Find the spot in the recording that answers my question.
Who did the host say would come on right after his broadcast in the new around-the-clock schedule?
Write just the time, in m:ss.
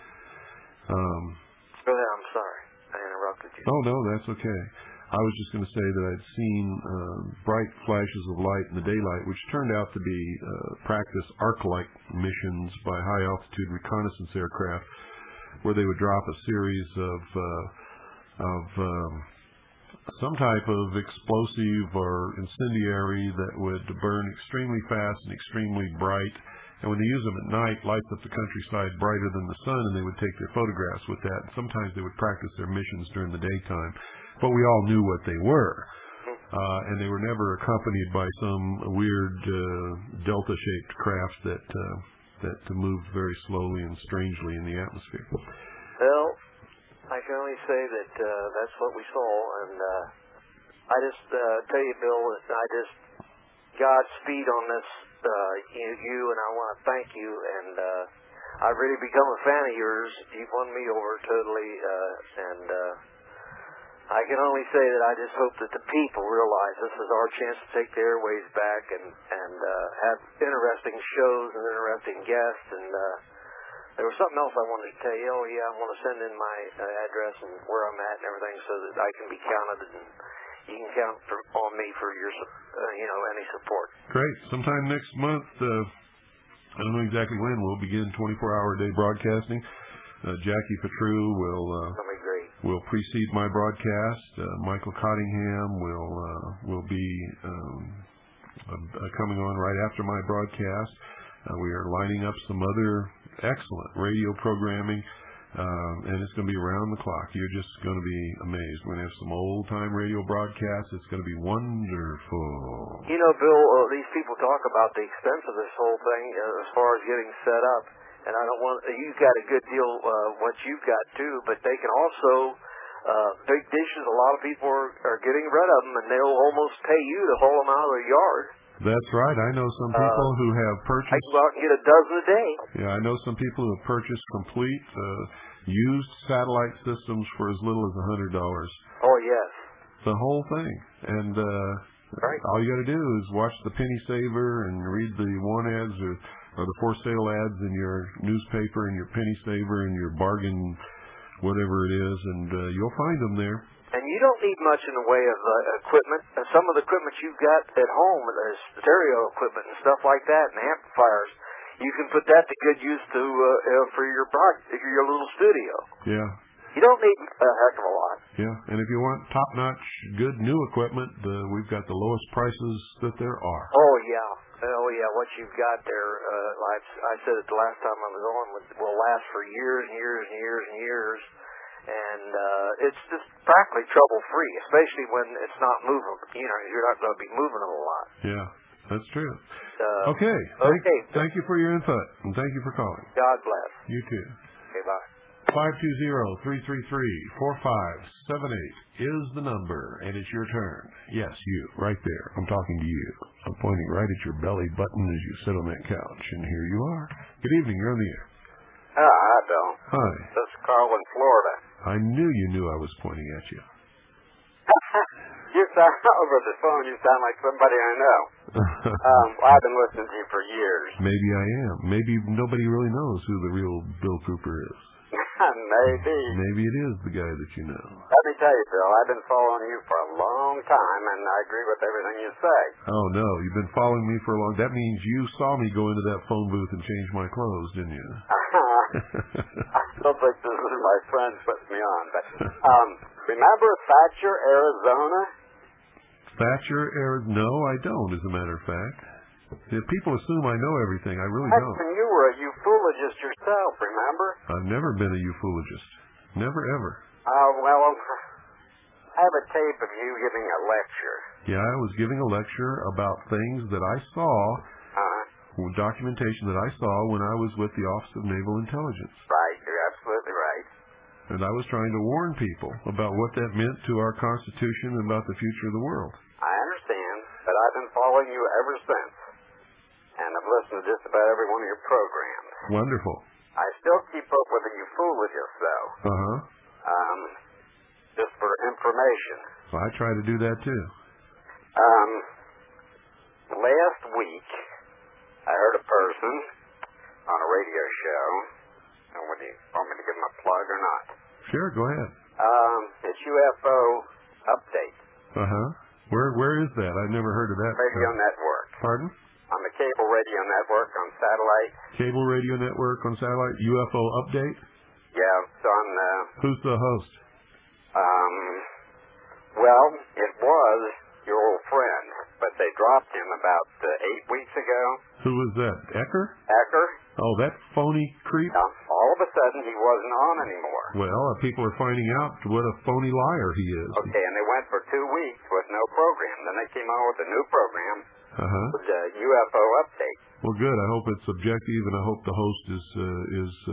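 1:34.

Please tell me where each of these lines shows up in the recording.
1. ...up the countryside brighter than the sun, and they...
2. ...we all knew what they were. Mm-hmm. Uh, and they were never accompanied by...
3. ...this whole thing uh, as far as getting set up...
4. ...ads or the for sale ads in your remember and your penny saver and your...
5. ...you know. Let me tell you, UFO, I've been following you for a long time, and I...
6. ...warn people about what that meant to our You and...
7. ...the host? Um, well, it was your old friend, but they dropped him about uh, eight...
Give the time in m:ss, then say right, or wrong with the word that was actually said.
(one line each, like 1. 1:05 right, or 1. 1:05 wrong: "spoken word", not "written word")
1. 0:28 right
2. 0:34 right
3. 1:55 right
4. 2:25 wrong: "newspaper", not "remember"
5. 3:47 wrong: "Phil", not "UFO"
6. 4:32 wrong: "Constitution", not "You"
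7. 5:16 right.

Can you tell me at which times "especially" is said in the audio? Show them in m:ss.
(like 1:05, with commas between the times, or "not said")
3:04.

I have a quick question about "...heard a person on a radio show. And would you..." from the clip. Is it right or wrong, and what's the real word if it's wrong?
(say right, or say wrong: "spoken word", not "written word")
right.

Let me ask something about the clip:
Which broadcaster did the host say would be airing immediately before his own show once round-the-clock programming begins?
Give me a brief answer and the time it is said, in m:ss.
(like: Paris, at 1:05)
Jackie Patru, at 1:30.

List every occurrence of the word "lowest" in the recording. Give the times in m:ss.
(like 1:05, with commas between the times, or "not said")
2:51.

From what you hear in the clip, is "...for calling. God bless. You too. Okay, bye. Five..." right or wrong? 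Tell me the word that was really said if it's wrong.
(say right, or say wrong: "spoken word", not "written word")
right.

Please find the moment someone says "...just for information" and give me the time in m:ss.
4:48.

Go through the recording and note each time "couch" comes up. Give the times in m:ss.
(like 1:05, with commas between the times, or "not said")
3:25.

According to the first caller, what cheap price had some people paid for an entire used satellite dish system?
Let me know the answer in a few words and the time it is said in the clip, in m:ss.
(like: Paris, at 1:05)
$100, at 2:17.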